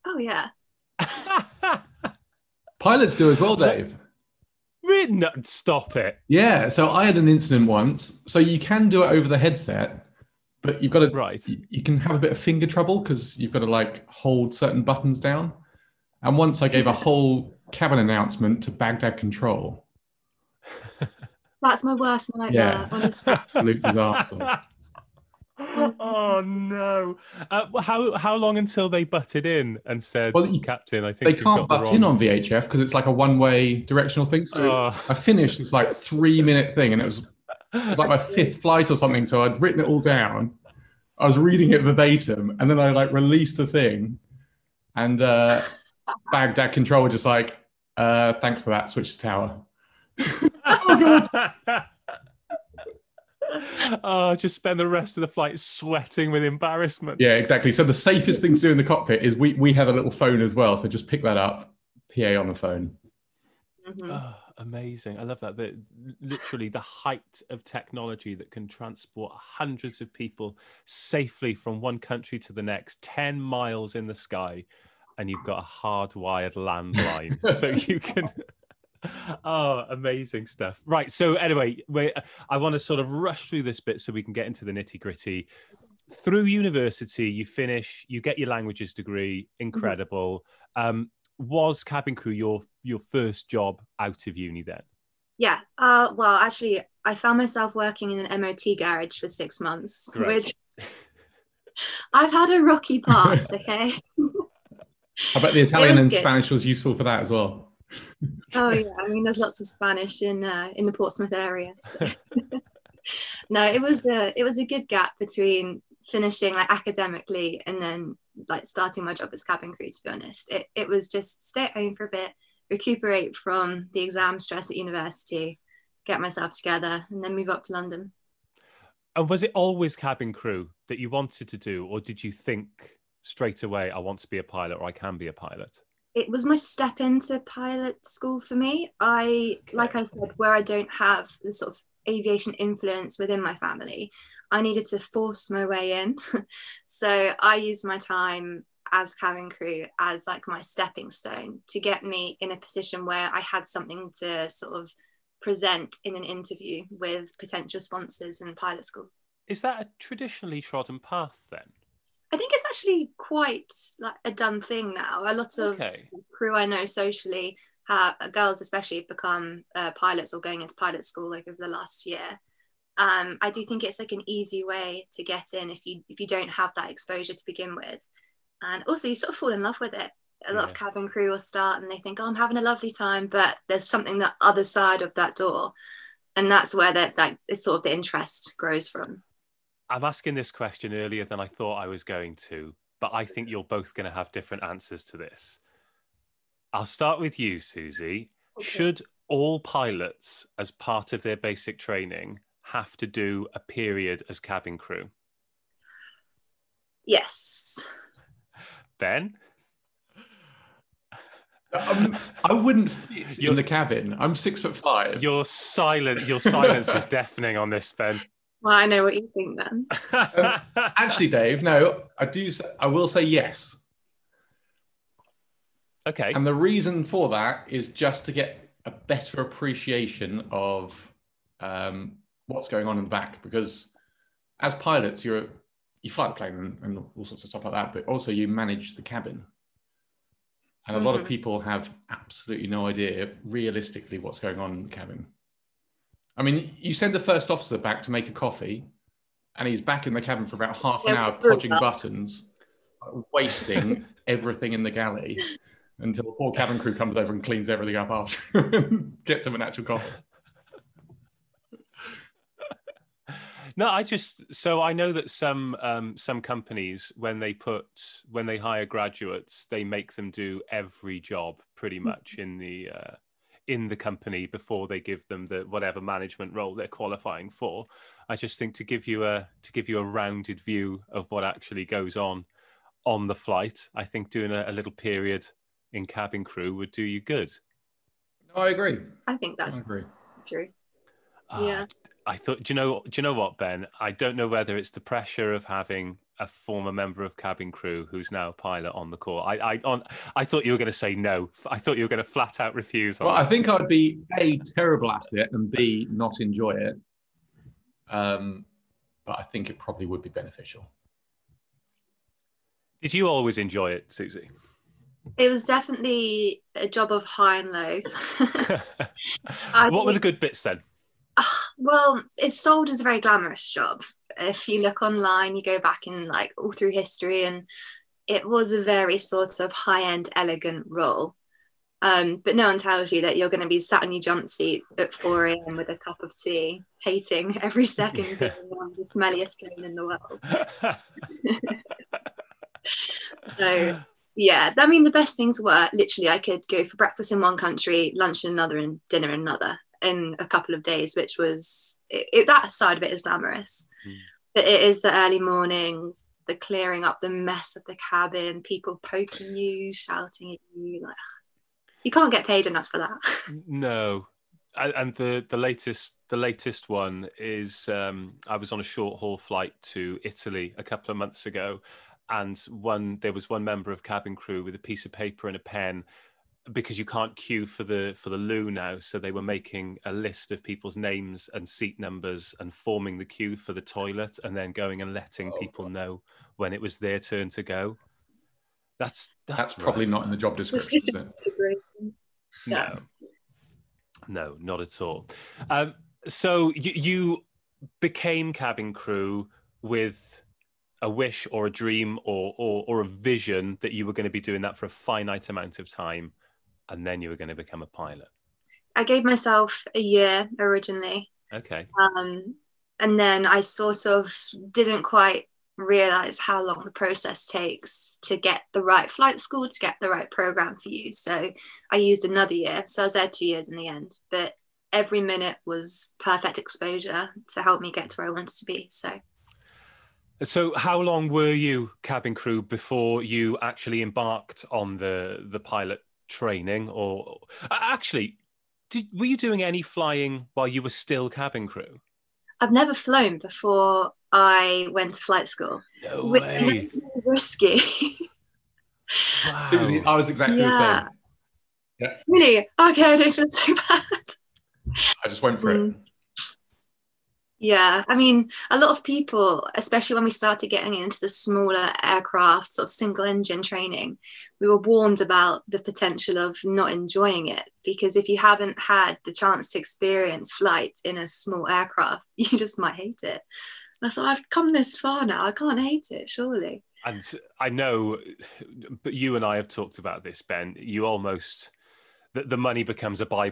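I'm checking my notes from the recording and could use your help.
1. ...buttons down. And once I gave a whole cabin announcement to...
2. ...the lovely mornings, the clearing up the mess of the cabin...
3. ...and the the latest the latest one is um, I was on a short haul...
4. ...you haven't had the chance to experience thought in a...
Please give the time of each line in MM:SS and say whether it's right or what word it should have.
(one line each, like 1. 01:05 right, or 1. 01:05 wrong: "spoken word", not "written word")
1. 00:14 right
2. 05:55 wrong: "early", not "lovely"
3. 06:04 right
4. 07:48 wrong: "flight", not "thought".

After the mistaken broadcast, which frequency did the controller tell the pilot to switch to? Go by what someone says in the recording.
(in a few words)
Tower.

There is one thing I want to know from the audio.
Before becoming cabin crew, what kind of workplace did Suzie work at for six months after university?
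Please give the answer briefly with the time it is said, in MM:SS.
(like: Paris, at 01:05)
An MOT garage, at 01:38.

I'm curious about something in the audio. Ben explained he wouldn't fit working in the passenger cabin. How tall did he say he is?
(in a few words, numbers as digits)
6 foot 5.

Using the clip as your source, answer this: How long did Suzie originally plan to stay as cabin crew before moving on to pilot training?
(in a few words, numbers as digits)
A year.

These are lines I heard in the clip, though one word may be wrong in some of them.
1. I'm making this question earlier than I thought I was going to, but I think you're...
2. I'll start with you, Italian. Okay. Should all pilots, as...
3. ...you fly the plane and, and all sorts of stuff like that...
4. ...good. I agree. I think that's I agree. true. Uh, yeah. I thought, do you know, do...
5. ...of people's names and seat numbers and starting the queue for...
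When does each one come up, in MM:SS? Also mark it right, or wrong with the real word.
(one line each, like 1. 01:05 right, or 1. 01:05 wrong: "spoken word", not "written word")
1. 03:09 wrong: "asking", not "making"
2. 03:16 wrong: "Suzie", not "Italian"
3. 03:56 right
4. 04:47 right
5. 06:20 wrong: "forming", not "starting".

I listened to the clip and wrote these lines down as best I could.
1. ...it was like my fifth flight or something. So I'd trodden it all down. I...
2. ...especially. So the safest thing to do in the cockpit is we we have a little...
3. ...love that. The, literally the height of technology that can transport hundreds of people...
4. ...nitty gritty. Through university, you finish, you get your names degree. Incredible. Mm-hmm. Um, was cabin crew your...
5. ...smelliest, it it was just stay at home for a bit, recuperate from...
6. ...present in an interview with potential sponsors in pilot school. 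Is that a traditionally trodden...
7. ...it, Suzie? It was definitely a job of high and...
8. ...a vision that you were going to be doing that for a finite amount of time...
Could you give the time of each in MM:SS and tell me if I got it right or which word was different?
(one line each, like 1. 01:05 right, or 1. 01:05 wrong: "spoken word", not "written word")
1. 00:37 wrong: "written", not "trodden"
2. 00:57 wrong: "exactly", not "especially"
3. 01:05 right
4. 01:24 wrong: "languages", not "names"
5. 02:00 wrong: "honest", not "smelliest"
6. 02:35 right
7. 05:13 right
8. 06:43 right.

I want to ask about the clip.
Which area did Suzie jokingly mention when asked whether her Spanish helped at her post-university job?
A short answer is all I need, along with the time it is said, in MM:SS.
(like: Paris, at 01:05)
Portsmouth, at 01:50.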